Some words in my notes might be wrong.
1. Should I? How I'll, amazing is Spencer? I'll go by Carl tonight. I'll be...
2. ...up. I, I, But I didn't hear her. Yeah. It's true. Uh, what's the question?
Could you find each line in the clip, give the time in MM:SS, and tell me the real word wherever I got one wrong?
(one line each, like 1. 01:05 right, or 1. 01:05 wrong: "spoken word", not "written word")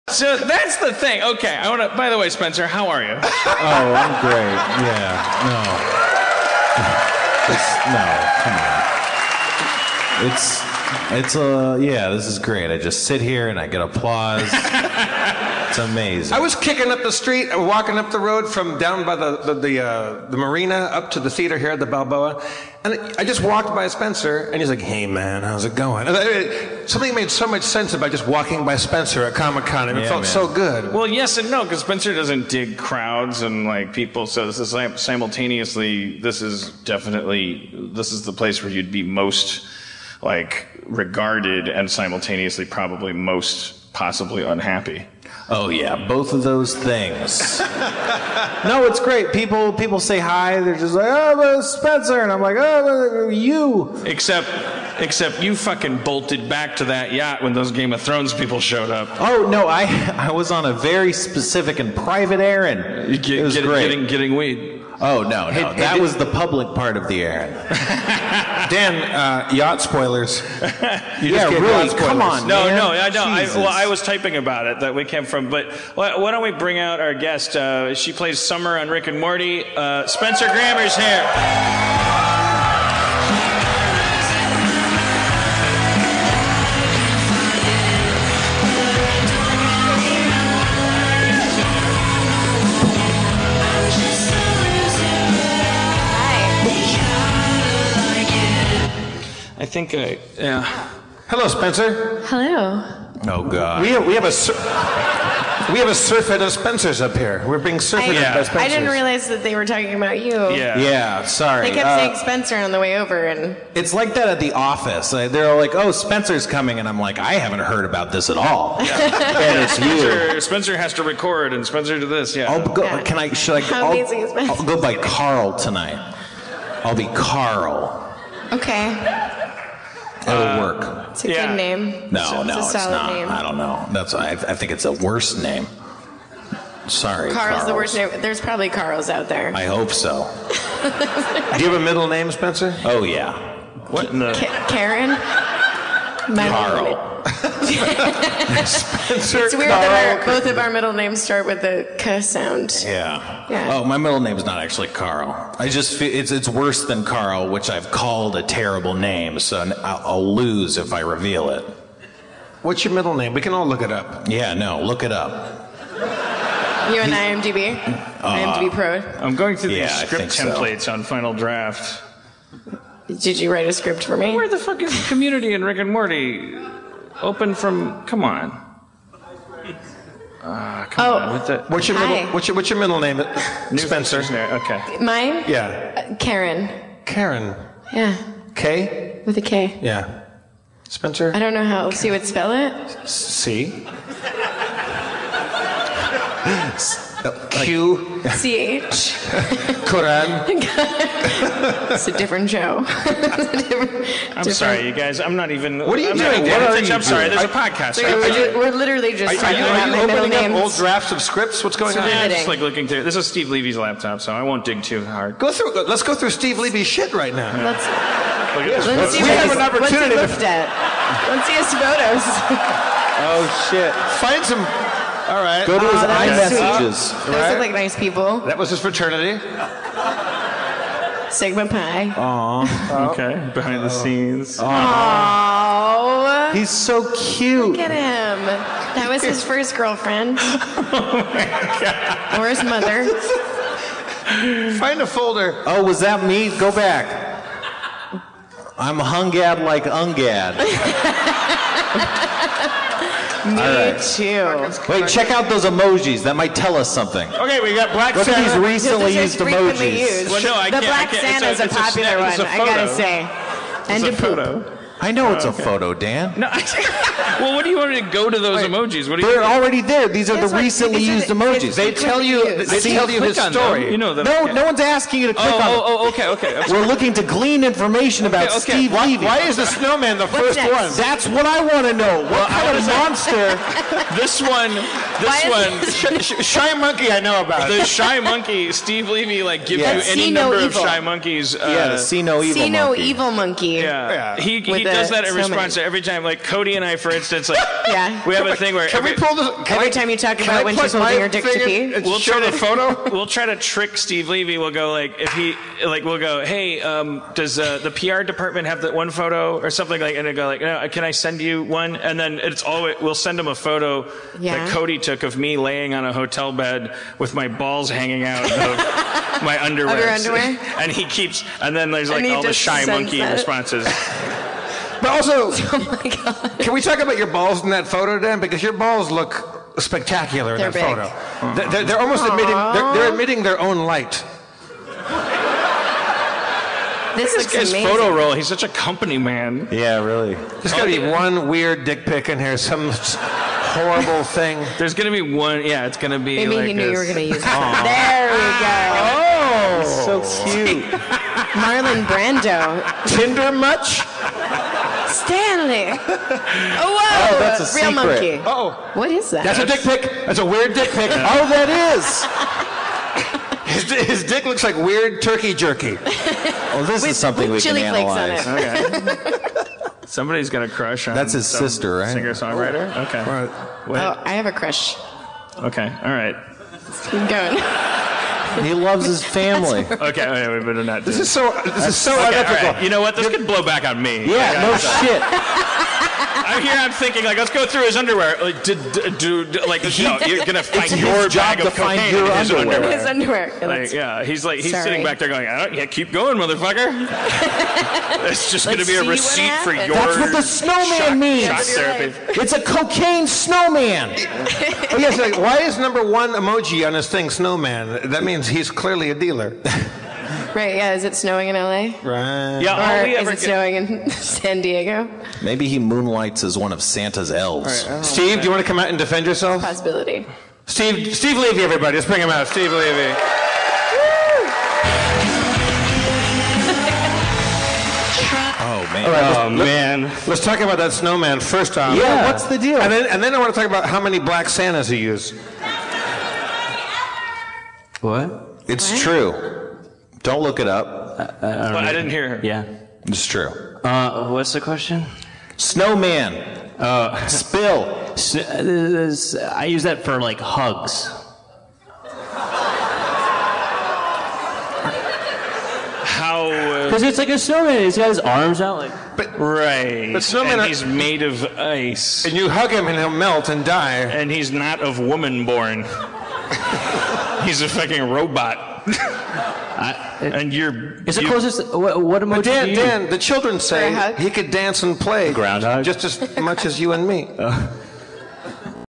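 1. 02:03 right
2. 07:20 right.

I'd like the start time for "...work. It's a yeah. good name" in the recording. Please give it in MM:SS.
02:10.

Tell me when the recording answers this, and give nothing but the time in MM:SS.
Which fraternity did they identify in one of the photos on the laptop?
03:51.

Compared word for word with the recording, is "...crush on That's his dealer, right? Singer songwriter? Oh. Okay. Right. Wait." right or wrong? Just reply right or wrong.
wrong.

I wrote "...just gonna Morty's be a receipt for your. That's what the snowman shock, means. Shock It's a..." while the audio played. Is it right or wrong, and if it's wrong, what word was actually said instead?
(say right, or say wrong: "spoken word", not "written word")
wrong: "Let", not "Morty".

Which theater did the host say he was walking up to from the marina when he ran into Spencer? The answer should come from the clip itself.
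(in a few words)
The Balboa.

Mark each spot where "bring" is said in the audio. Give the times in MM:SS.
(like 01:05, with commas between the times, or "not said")
01:16, 07:02.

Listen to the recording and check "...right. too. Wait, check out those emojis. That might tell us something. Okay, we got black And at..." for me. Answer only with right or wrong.
wrong.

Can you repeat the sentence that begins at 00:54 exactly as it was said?
Except Except you fucking bolted back to that yacht when those Game of Thrones people showed up.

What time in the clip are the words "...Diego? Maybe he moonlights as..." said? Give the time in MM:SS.
06:54.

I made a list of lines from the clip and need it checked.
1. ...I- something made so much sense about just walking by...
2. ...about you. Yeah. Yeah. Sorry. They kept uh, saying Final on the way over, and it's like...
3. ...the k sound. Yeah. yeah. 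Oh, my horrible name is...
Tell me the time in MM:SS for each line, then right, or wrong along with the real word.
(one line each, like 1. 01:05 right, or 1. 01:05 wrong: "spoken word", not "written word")
1. 00:26 right
2. 01:49 wrong: "Spencer", not "Final"
3. 02:31 wrong: "middle", not "horrible".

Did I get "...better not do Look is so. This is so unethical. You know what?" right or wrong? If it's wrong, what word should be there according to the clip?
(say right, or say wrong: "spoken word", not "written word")
wrong: "This", not "Look".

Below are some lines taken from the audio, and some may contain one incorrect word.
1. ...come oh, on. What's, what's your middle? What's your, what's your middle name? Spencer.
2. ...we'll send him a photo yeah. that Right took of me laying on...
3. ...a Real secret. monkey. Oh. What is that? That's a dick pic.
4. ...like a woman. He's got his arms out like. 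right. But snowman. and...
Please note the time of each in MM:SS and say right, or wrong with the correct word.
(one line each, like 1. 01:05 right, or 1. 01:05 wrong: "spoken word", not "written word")
1. 03:00 right
2. 05:13 wrong: "Cody", not "Right"
3. 05:57 right
4. 07:37 wrong: "snowman", not "woman".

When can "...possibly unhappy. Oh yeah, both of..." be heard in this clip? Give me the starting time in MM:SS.
00:43.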